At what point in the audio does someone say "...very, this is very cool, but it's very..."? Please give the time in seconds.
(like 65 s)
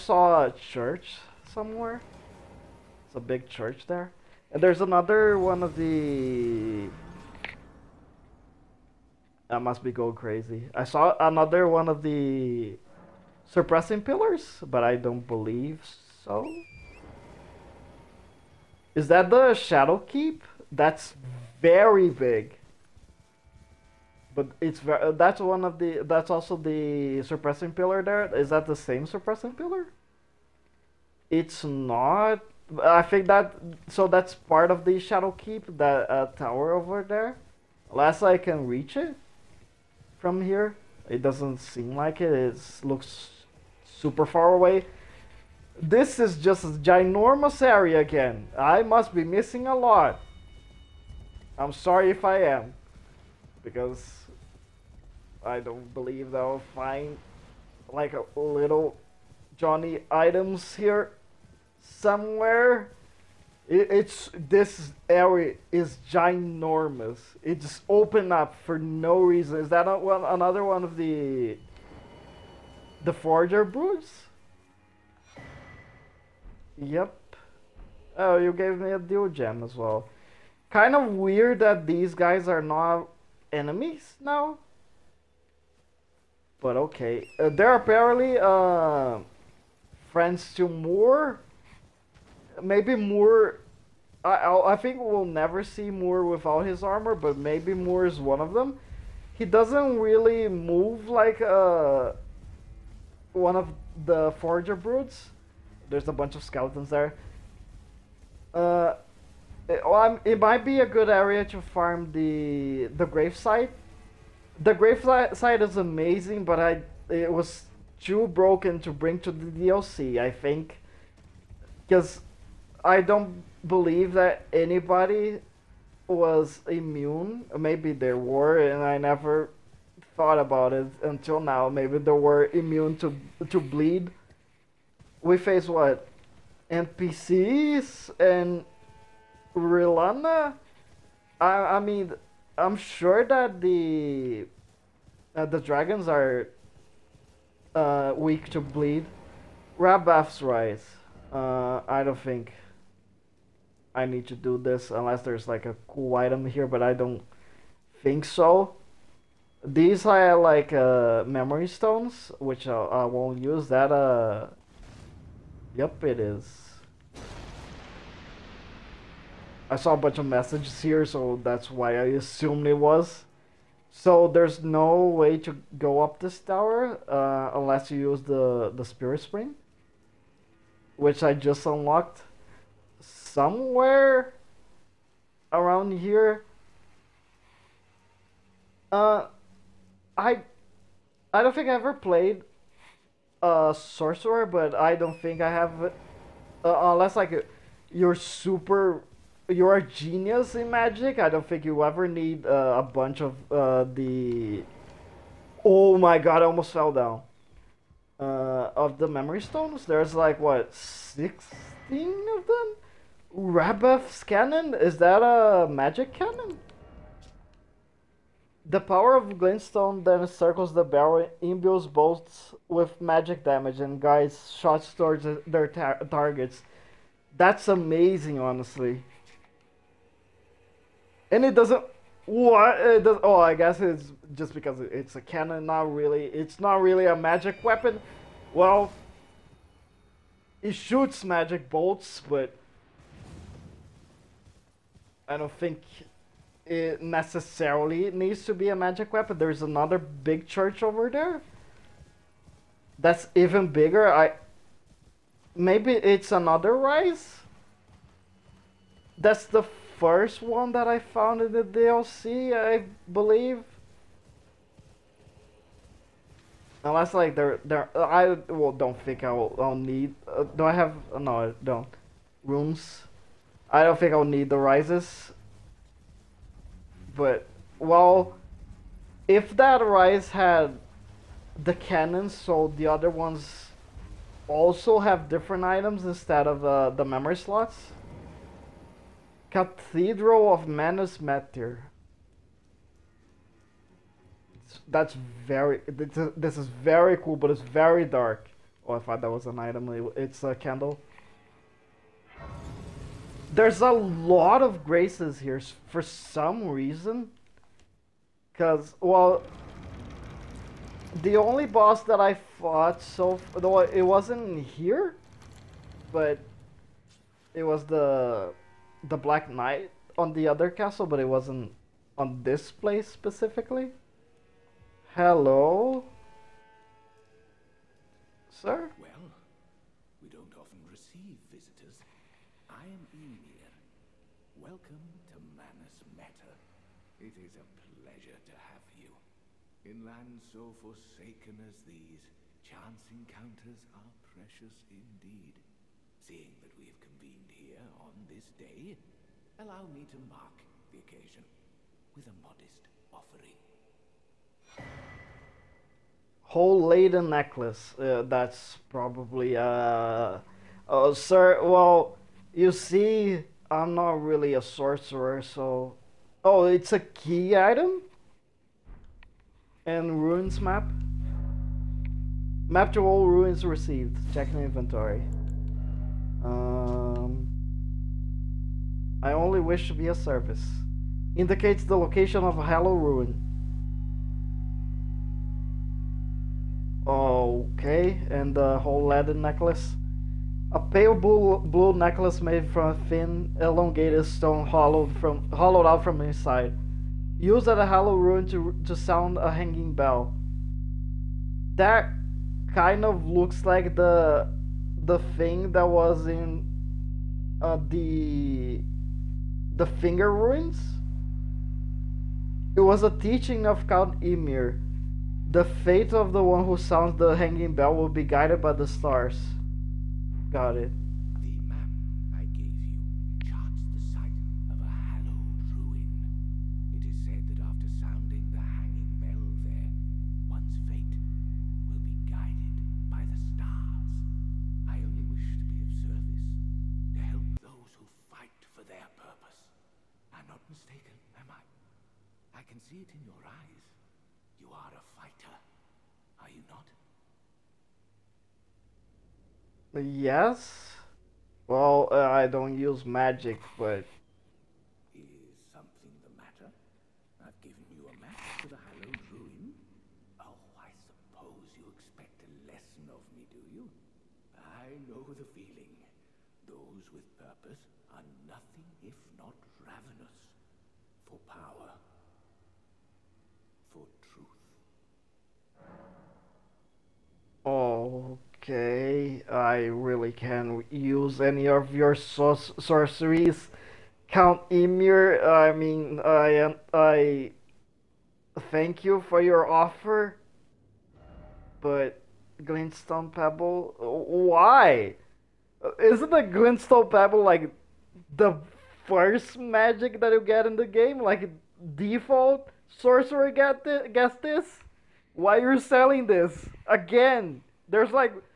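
295 s.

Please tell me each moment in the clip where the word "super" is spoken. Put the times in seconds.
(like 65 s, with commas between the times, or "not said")
43 s, 198 s.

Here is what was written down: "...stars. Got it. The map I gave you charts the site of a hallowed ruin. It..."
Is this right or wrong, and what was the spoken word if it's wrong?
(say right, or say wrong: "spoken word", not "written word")
right.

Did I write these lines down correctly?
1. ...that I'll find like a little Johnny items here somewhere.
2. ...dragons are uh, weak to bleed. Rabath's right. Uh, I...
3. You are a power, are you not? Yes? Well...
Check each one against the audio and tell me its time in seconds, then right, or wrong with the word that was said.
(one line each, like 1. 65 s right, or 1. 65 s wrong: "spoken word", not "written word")
1. 56 s right
2. 145 s right
3. 444 s wrong: "fighter", not "power".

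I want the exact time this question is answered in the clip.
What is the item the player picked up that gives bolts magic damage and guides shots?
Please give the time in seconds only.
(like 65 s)
213 s.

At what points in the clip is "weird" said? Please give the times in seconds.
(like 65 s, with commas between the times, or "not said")
81 s.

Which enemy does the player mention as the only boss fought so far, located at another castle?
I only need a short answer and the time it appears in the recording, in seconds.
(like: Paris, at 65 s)
Black Knight, at 319 s.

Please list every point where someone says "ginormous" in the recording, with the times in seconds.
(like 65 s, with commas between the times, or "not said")
46 s, 66 s.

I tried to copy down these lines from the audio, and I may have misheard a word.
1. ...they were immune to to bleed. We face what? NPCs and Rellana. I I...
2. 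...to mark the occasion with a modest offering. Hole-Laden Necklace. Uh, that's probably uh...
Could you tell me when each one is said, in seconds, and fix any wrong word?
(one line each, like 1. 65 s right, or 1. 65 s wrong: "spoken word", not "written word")
1. 131 s right
2. 350 s right.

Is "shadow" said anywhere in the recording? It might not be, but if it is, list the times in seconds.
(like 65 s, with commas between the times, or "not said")
19 s, 34 s.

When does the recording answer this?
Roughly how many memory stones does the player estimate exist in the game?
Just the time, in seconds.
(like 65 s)
210 s.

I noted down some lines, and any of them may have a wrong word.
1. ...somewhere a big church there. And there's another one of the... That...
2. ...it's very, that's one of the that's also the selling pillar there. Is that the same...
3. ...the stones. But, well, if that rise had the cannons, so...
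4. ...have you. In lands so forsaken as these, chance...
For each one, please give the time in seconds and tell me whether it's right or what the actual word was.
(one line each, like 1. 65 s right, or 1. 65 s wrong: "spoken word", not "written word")
1. 1 s right
2. 24 s wrong: "suppressing", not "selling"
3. 274 s wrong: "rises", not "stones"
4. 338 s right.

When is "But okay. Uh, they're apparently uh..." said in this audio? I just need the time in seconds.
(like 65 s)
86 s.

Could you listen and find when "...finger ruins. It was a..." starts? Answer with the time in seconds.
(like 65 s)
409 s.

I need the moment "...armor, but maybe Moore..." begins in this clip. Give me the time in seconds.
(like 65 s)
96 s.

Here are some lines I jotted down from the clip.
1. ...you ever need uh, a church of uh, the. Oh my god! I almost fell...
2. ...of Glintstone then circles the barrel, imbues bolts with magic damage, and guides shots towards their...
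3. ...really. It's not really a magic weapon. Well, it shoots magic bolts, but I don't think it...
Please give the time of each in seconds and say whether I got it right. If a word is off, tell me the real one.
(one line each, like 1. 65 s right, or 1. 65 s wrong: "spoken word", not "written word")
1. 201 s wrong: "bunch", not "church"
2. 219 s right
3. 235 s right.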